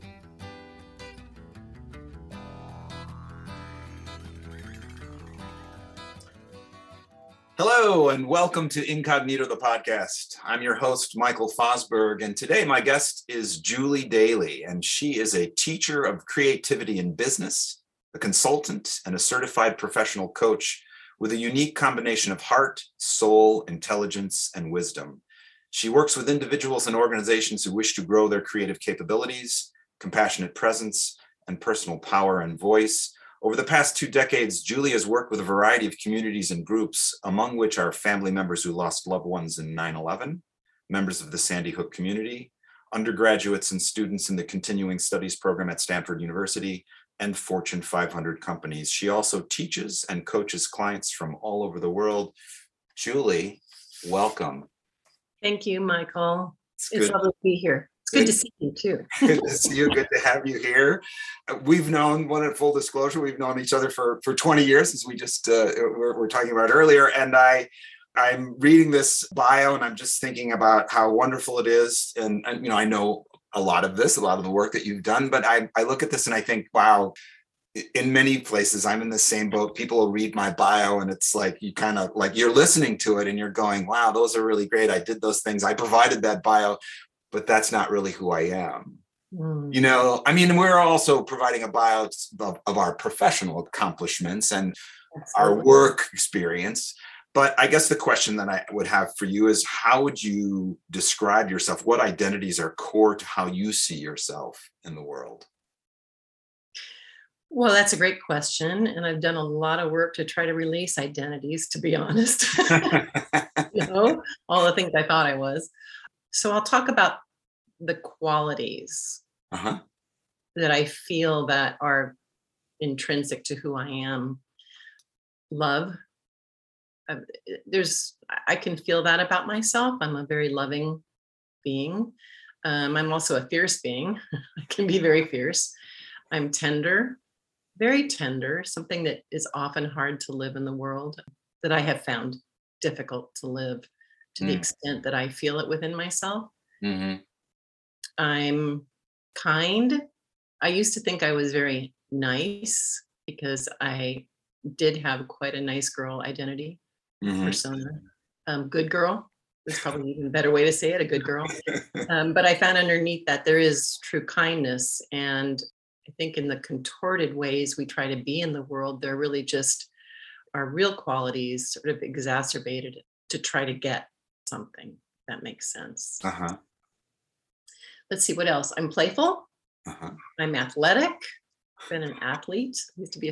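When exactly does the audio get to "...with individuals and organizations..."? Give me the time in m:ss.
0:26.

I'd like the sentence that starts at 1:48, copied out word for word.
And I've done a lot of work to try to release identities, to be honest.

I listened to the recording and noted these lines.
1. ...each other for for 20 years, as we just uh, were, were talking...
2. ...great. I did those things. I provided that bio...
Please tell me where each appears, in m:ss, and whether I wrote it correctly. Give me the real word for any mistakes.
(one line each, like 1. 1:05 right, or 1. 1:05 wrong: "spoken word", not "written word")
1. 1:03 right
2. 1:24 right.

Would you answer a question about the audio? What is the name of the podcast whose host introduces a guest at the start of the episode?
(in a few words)
Incognito.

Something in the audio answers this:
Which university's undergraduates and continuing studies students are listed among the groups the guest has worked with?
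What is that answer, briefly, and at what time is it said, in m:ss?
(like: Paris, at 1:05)
Stanford University, at 0:45.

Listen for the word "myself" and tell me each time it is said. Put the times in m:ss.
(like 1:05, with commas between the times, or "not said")
2:09, 2:25.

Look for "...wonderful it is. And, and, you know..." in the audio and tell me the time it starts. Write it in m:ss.
1:11.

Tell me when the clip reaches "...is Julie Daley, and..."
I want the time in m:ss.
0:13.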